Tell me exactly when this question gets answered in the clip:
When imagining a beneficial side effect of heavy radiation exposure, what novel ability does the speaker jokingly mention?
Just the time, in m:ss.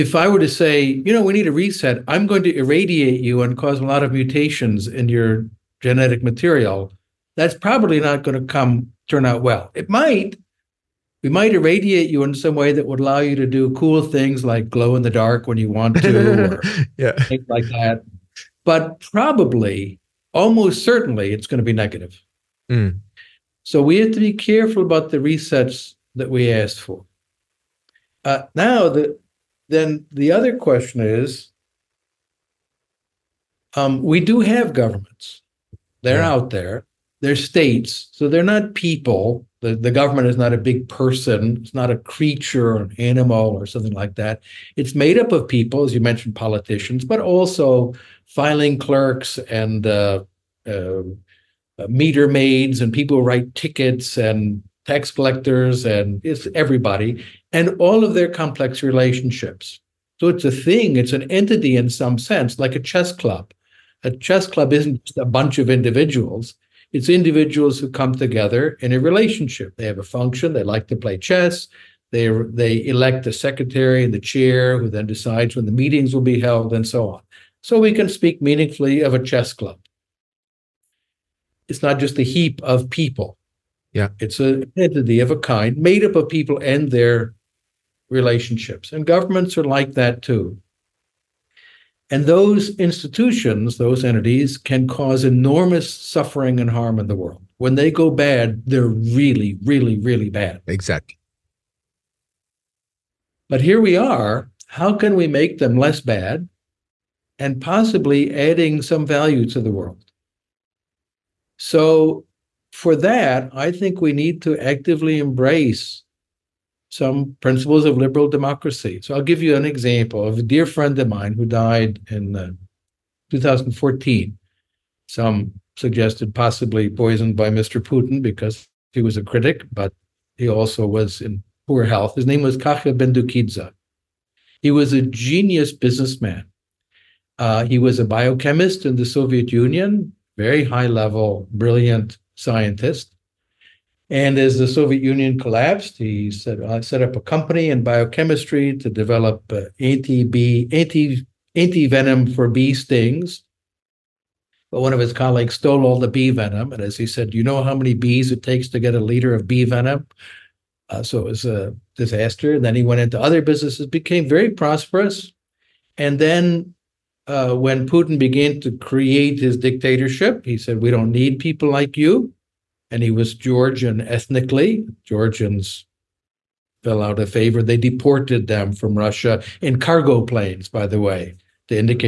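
0:14.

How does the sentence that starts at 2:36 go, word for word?
And as he said, do you know how many bees it takes to get a liter of bee venom?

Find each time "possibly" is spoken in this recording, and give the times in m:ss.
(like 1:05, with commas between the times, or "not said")
1:47, 2:06.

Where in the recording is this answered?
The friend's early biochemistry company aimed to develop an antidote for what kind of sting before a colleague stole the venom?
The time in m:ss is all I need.
2:32.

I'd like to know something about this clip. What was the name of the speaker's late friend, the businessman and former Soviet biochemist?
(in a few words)
Kakha Bendukidze.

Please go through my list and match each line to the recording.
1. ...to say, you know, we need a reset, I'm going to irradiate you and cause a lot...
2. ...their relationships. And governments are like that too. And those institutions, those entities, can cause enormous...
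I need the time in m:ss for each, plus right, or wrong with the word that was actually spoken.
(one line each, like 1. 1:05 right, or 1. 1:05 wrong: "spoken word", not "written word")
1. 0:00 right
2. 1:26 right.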